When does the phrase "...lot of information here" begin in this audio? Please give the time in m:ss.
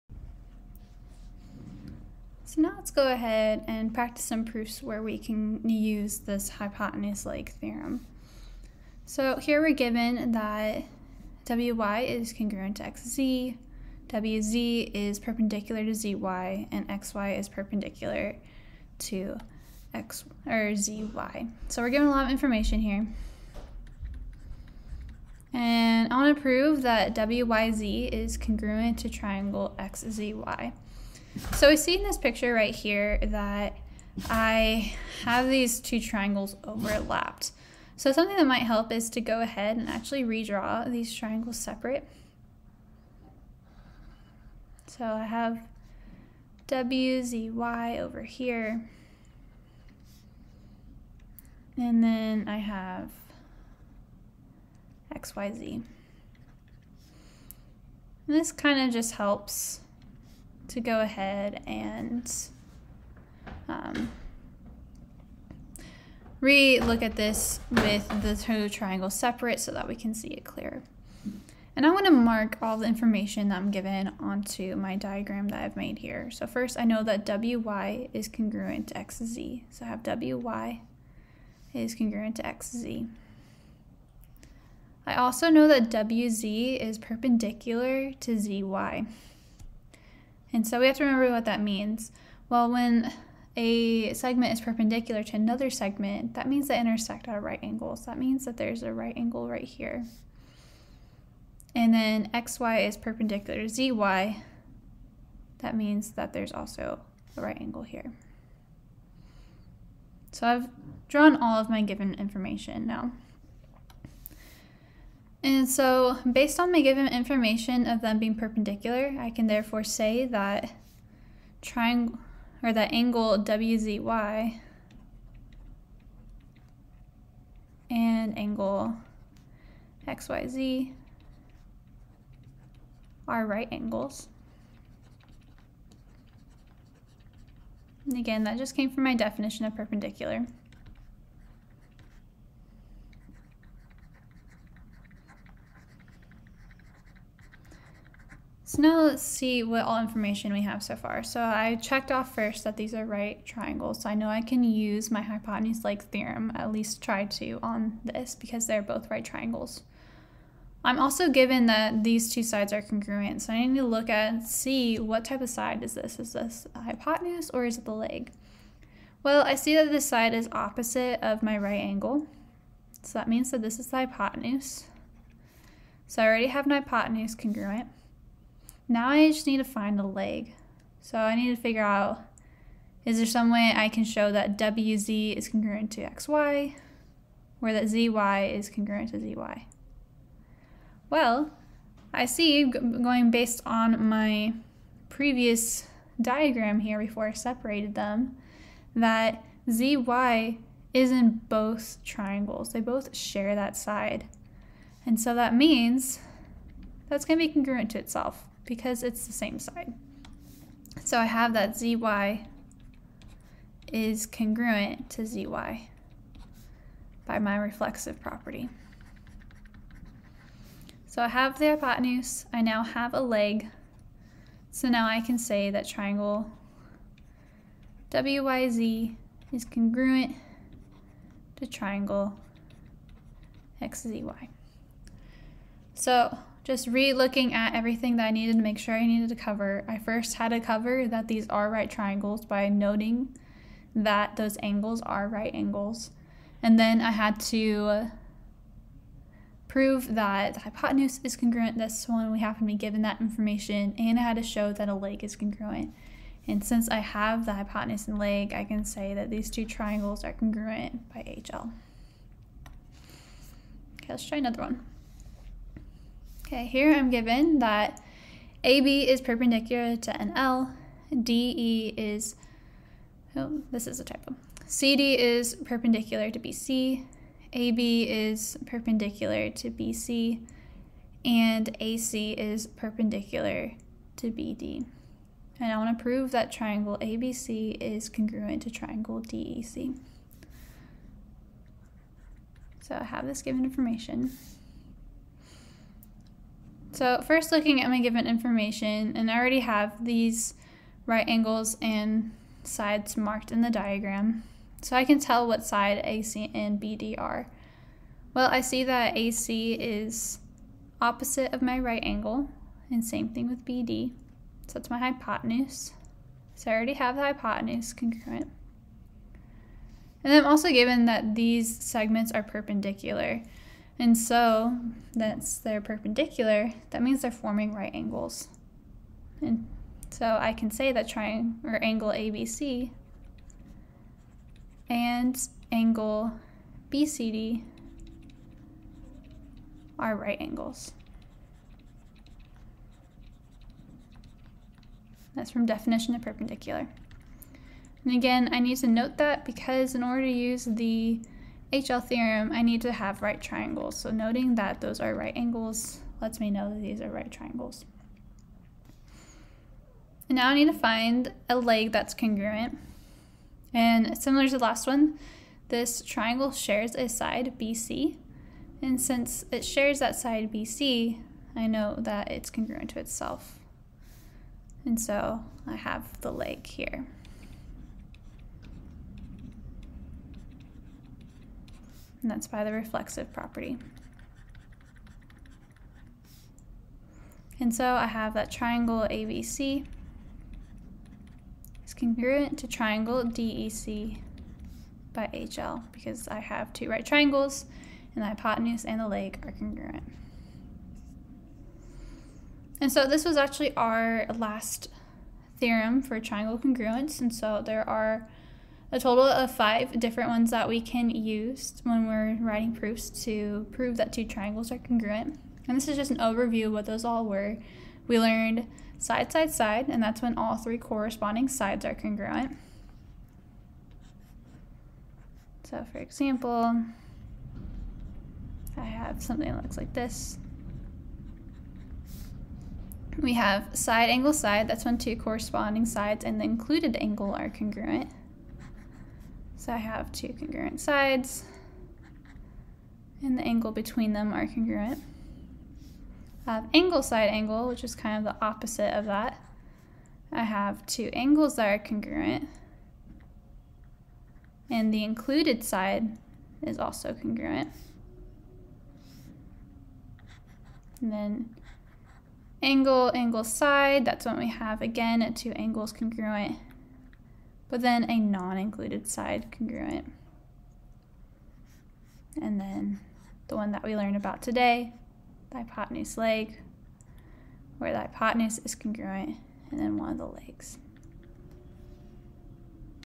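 0:22.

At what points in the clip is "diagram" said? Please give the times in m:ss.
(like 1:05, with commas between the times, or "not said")
1:14, 3:16, 5:03.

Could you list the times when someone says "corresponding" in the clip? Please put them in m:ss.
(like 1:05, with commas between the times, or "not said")
7:00, 7:15.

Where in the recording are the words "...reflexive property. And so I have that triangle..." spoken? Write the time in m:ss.
6:22.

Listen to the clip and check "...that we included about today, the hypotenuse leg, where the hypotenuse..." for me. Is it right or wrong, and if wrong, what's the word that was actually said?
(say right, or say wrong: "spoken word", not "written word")
wrong: "learned", not "included".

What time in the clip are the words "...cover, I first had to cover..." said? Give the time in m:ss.
3:59.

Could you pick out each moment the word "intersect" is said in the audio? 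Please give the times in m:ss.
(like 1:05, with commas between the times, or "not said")
1:36.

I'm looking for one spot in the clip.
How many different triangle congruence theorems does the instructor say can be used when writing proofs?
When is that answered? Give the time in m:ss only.
6:49.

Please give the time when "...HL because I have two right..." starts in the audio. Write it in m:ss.
6:35.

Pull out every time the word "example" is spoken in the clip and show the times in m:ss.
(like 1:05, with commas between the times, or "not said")
7:05.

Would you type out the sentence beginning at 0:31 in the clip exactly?
So we see in this picture right here that I have these two triangles overlapped.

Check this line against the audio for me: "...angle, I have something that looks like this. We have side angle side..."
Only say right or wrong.
wrong.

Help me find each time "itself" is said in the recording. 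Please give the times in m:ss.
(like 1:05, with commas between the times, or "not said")
3:27, 6:12.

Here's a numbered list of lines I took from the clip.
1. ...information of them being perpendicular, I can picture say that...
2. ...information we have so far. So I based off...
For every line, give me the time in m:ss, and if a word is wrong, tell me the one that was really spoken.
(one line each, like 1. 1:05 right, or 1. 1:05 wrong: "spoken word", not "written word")
1. 1:57 wrong: "therefore", not "picture"
2. 2:30 wrong: "checked", not "based".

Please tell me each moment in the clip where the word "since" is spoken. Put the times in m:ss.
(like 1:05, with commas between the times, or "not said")
4:16, 6:08.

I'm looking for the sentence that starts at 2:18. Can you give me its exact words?
And again, that just came from my definition of perpendicular.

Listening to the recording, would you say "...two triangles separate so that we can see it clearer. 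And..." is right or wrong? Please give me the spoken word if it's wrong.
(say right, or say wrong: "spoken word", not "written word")
right.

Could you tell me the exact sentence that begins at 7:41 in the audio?
And then angle, angle side, that's when we have again two angles congruent but then a non-included side congruent.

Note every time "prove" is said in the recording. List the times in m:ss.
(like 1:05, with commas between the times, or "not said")
0:26, 4:09, 4:46, 6:53.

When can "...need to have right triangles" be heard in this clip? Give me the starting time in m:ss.
5:52.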